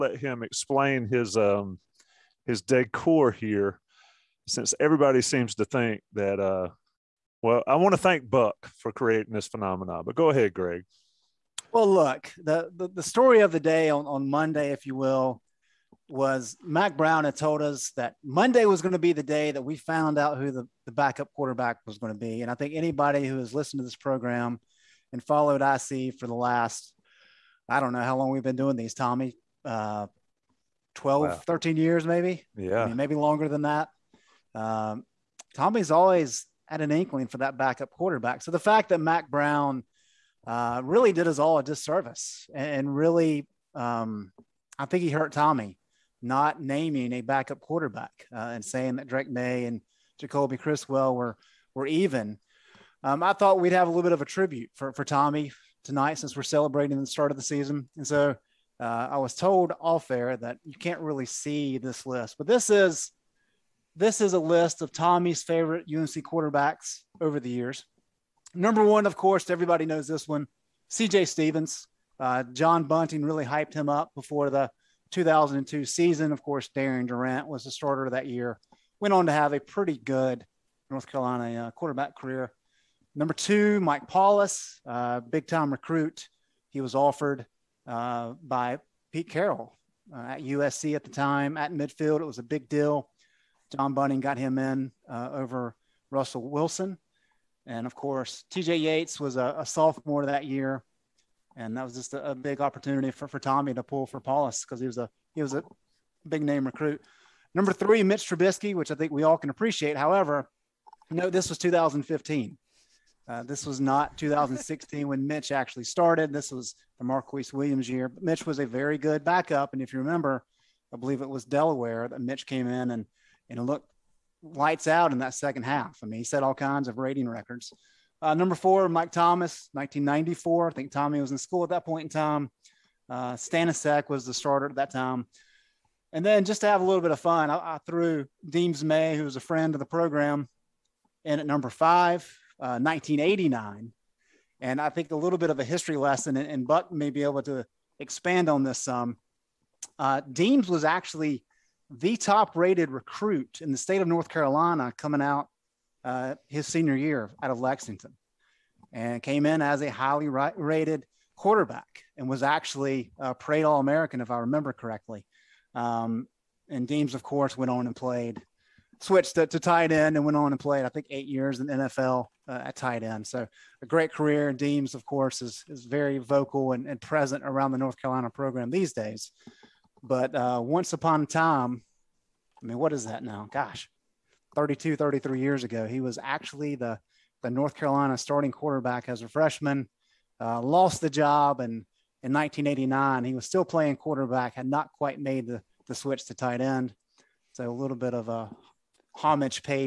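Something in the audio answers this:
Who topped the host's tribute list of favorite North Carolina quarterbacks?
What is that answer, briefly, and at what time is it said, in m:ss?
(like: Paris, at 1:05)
C.J. Stephens, at 1:10.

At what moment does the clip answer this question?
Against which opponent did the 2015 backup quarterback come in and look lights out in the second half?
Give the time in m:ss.
2:01.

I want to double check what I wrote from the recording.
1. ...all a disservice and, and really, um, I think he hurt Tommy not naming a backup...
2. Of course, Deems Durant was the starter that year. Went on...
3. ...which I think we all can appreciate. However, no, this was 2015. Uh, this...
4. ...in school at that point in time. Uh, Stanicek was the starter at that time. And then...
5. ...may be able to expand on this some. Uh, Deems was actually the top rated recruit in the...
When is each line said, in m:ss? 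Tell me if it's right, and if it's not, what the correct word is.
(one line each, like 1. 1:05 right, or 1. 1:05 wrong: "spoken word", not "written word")
1. 0:41 right
2. 1:16 wrong: "Darian", not "Deems"
3. 1:48 right
4. 2:11 right
5. 2:26 right.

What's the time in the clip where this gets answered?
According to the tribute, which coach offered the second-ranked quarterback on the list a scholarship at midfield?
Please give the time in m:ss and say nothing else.
1:29.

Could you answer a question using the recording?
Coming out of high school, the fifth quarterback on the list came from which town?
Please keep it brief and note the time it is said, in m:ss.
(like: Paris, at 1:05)
Lexington, at 2:37.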